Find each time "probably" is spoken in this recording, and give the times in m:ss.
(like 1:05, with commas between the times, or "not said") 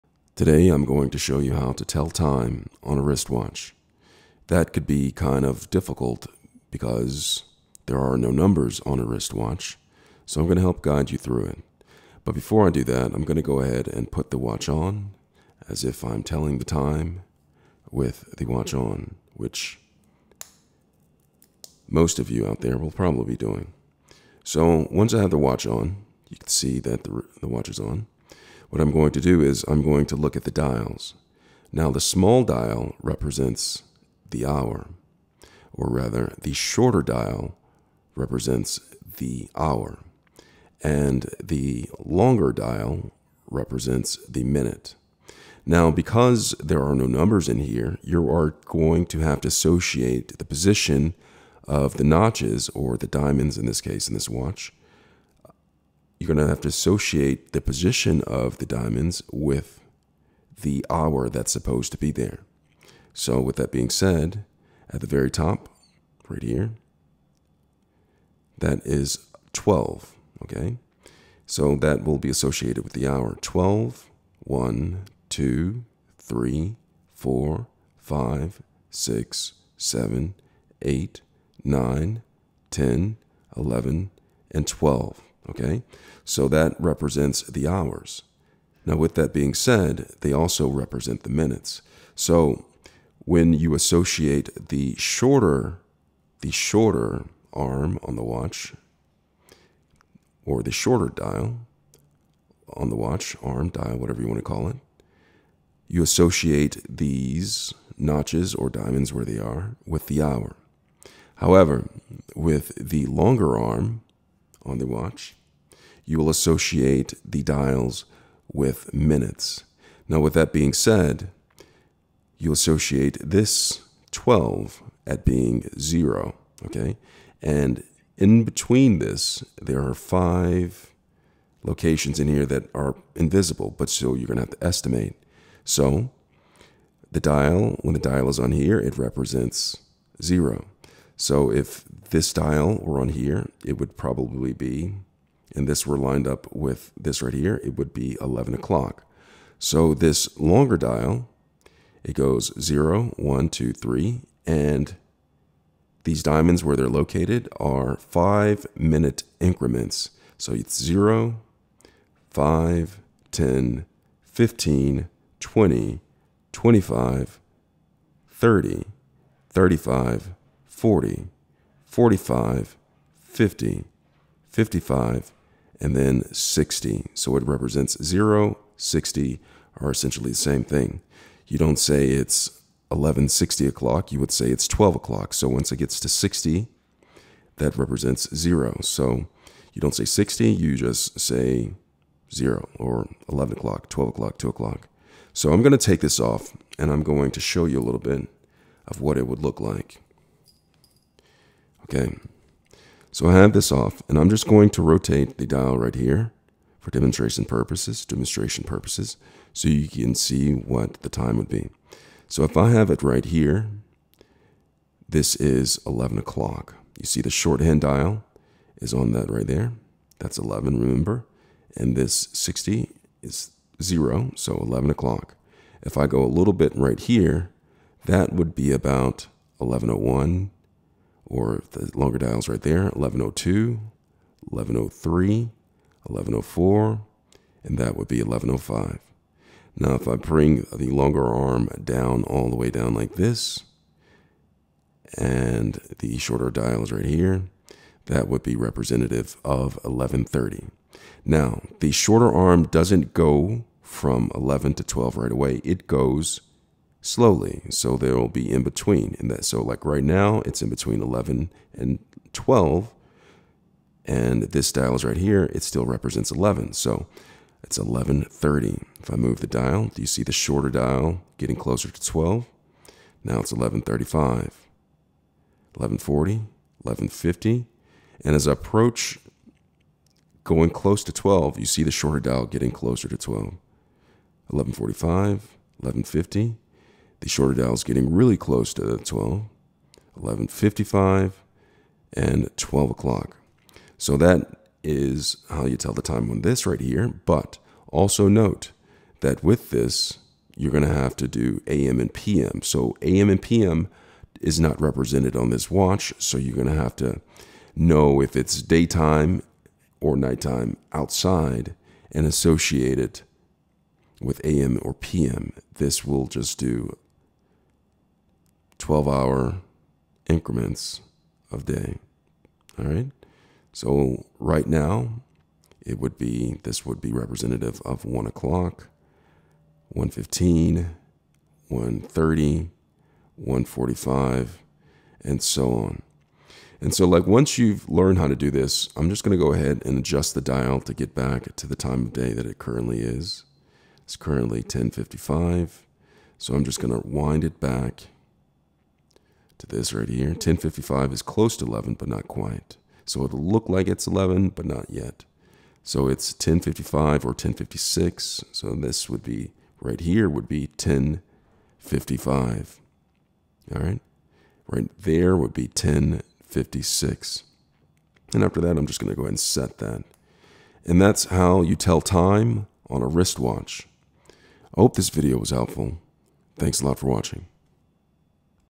0:22, 2:23.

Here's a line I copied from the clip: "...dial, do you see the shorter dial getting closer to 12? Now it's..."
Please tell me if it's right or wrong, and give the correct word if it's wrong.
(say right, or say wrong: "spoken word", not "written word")
right.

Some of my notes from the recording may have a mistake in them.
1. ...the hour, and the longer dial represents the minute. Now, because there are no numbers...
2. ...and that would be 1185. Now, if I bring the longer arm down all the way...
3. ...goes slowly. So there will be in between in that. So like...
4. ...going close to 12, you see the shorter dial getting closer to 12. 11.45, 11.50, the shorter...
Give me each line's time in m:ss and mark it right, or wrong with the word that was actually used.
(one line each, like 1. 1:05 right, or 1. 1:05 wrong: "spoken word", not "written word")
1. 0:39 right
2. 3:57 wrong: "1105", not "1185"
3. 4:15 right
4. 4:40 right.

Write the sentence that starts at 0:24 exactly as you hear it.
So once I have the watch on, you can see that the, the watch is on.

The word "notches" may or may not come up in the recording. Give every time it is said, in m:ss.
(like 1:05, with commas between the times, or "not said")
0:52, 1:47.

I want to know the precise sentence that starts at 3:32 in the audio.
So if I have it right here, this is 11 o'clock.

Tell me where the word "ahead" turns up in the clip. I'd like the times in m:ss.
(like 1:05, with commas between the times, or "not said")
0:13, 5:39, 6:09.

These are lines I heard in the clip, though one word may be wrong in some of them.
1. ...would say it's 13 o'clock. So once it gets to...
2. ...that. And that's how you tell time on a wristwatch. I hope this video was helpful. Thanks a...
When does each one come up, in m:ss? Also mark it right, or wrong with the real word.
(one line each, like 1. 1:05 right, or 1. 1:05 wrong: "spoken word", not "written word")
1. 3:04 wrong: "12", not "13"
2. 6:09 right.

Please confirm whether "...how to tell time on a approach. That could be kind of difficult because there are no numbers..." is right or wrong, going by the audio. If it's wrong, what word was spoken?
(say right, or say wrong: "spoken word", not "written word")
wrong: "wristwatch", not "approach".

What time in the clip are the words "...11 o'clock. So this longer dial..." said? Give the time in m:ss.
2:28.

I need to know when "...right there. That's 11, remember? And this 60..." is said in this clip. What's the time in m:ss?
3:39.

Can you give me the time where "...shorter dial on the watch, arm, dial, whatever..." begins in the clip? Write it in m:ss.
1:40.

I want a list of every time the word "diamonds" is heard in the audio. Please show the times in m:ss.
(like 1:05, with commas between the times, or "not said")
0:53, 0:58, 1:48, 2:36.